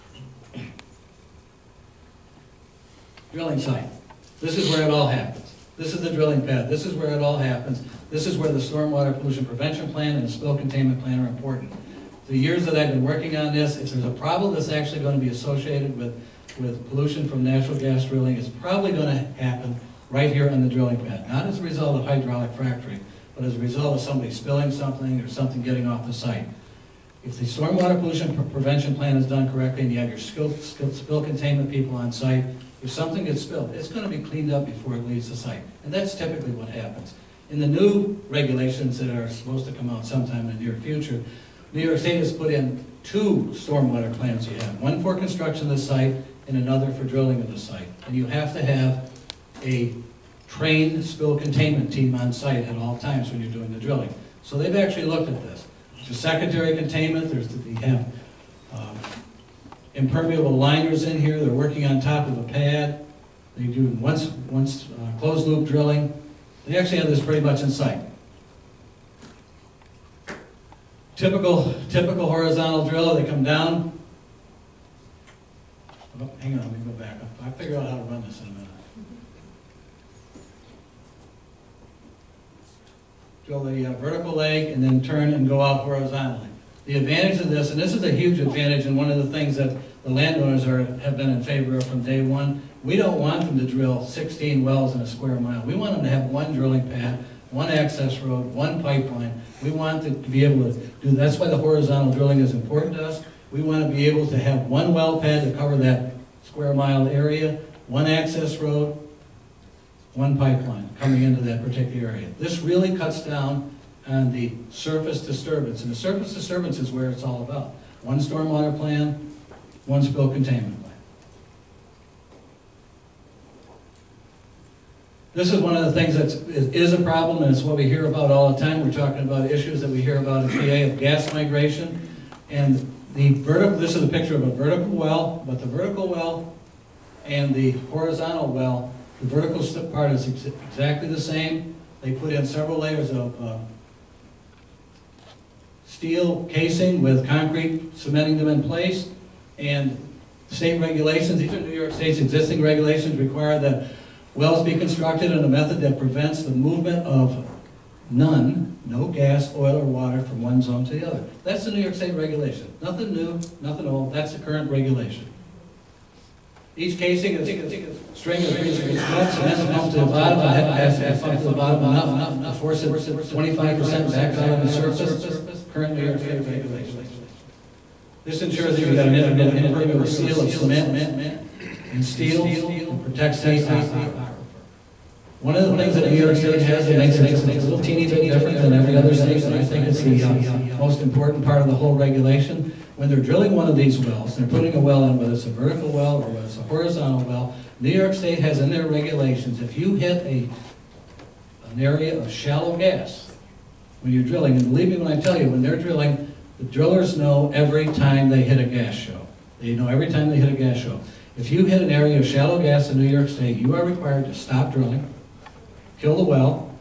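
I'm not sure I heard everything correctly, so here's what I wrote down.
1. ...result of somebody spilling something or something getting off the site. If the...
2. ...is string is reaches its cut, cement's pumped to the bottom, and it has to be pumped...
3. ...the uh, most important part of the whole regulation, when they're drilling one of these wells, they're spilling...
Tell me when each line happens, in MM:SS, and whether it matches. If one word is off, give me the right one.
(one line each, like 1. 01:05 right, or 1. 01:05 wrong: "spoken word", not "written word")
1. 00:23 right
2. 02:47 right
3. 03:10 wrong: "putting", not "spilling".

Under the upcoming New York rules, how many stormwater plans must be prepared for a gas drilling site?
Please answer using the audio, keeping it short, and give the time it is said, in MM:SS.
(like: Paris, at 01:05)
2, at 00:43.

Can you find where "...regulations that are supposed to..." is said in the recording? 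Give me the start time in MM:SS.
00:38.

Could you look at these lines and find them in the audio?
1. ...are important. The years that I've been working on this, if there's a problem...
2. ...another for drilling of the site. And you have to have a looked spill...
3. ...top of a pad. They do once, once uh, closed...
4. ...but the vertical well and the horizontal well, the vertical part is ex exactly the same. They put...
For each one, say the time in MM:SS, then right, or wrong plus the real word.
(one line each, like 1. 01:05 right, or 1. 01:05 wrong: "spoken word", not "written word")
1. 00:11 right
2. 00:46 wrong: "trained", not "looked"
3. 01:01 right
4. 02:15 right.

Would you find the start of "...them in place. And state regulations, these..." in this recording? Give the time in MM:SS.
02:28.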